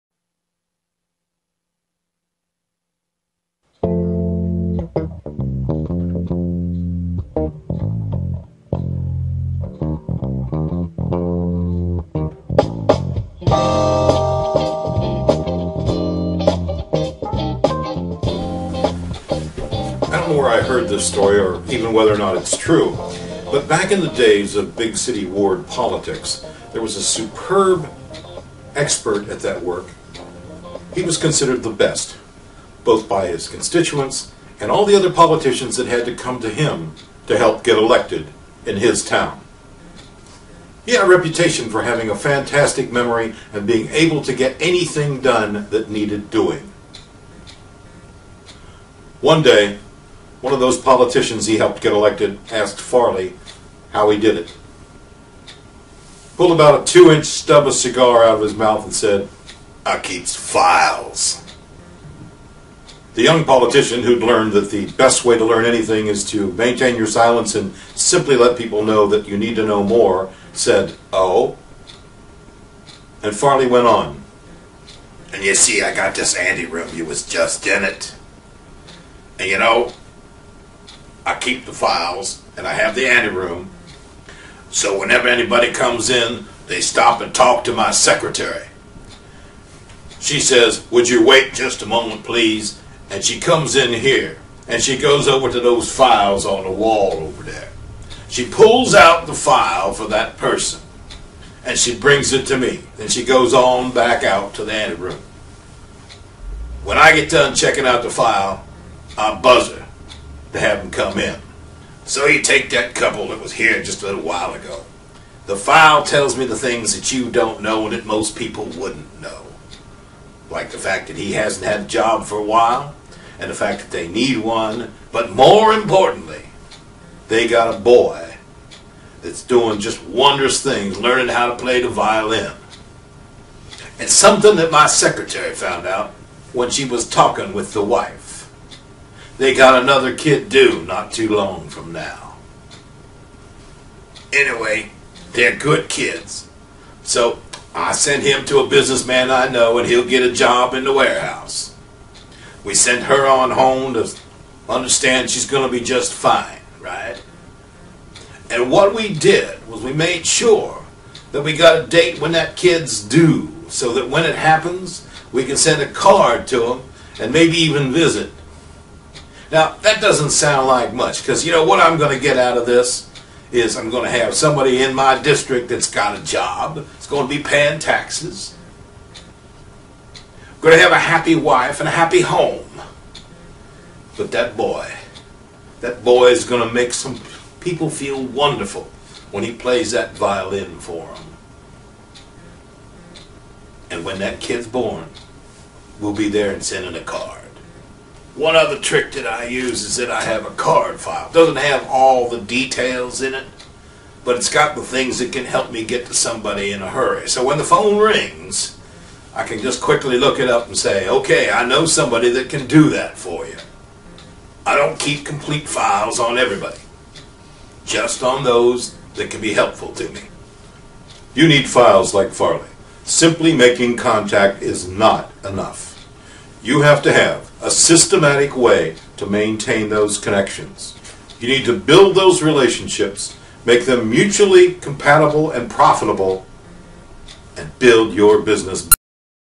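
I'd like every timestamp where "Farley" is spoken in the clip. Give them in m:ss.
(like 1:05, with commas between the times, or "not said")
0:52, 1:13, 3:42.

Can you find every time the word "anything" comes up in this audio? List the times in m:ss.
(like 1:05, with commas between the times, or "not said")
0:44, 1:05.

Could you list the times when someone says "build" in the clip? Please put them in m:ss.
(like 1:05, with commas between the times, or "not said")
3:51, 3:57.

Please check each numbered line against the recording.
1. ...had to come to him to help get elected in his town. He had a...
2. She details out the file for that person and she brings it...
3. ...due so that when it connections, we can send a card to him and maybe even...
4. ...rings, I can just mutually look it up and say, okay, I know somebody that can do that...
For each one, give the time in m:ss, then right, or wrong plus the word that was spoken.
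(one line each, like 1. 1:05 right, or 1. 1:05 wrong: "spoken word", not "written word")
1. 0:35 right
2. 1:38 wrong: "pulls", not "details"
3. 2:43 wrong: "happens", not "connections"
4. 3:27 wrong: "quickly", not "mutually".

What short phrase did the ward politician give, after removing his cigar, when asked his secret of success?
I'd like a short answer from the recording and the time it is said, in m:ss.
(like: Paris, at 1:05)
I keeps files, at 0:59.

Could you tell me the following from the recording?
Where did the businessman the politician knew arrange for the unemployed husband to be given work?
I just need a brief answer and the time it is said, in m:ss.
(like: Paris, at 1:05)
the warehouse, at 2:30.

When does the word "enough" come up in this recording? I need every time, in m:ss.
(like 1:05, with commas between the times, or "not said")
3:45.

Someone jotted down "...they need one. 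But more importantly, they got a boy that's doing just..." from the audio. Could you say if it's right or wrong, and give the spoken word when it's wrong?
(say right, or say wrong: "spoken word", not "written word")
right.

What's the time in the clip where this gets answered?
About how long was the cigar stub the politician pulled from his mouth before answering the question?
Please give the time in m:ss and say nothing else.
0:56.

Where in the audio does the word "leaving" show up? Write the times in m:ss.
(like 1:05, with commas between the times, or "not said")
not said.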